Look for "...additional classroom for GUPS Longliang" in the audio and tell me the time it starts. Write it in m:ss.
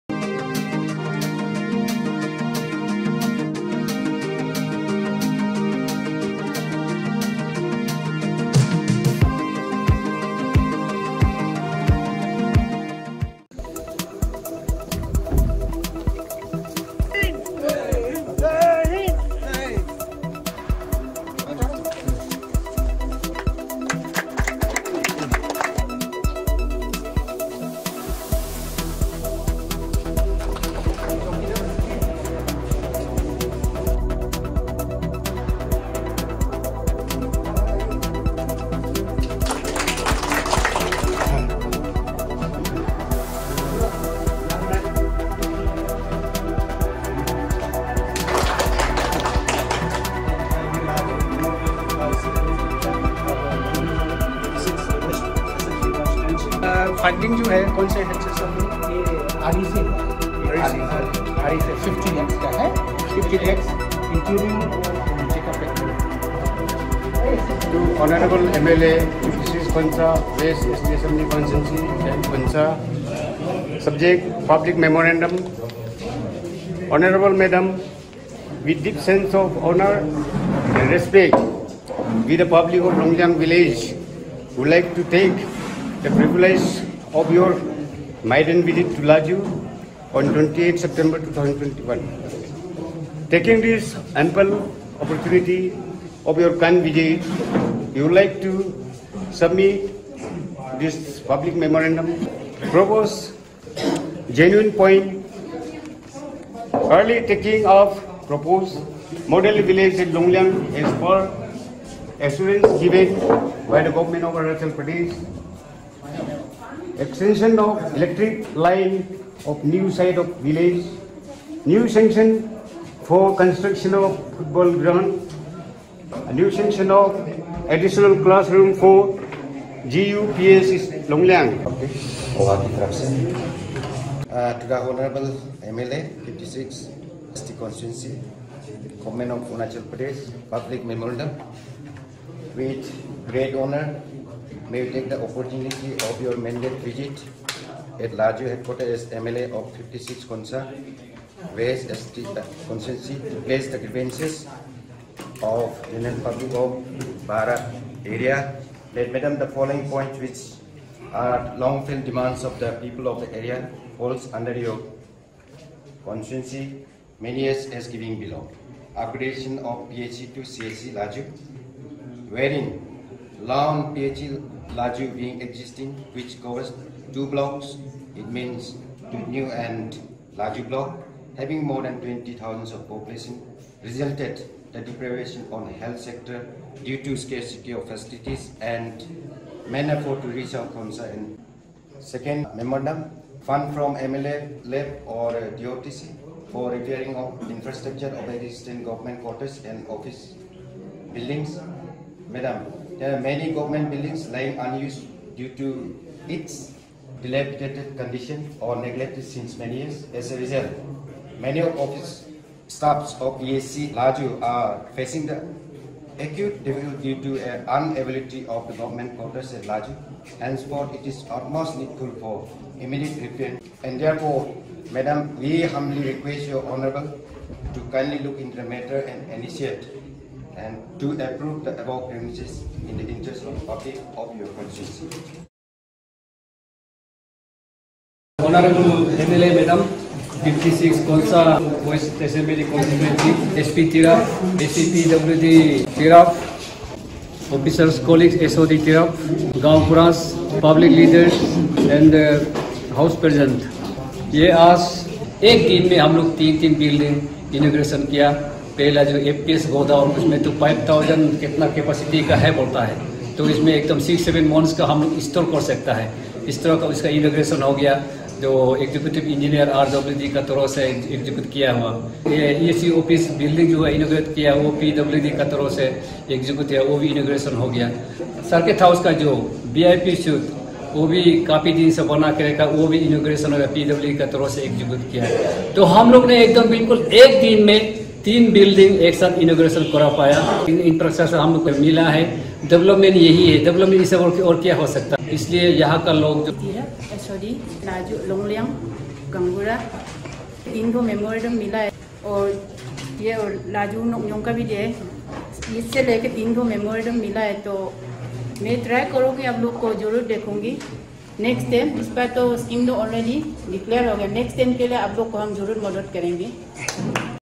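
2:07.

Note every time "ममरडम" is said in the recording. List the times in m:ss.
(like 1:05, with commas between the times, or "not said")
1:14, 5:01, 5:06.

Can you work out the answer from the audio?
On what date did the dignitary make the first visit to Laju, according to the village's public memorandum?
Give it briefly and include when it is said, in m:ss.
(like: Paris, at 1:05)
28 September 2021, at 1:30.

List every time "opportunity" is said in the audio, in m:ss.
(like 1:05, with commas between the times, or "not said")
1:35, 2:25.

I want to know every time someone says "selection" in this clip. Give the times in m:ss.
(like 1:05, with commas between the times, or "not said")
not said.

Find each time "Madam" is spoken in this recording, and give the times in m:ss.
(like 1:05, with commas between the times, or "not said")
2:39, 3:22, 3:44, 3:59.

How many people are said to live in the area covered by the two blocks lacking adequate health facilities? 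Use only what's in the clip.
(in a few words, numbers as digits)
More than 20,000.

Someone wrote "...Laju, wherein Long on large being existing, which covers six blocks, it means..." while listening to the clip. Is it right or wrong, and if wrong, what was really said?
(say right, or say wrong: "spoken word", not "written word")
wrong: "two", not "six".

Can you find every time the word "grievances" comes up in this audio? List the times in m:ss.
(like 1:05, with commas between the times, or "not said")
2:33.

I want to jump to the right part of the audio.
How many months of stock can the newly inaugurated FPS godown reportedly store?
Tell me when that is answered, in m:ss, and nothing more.
4:24.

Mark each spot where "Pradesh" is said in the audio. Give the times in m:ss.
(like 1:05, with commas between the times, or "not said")
1:54, 2:19.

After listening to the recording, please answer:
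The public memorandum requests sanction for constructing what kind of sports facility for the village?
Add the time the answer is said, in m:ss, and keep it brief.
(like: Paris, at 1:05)
Football ground, at 2:04.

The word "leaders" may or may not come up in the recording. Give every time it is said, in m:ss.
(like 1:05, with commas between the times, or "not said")
4:10.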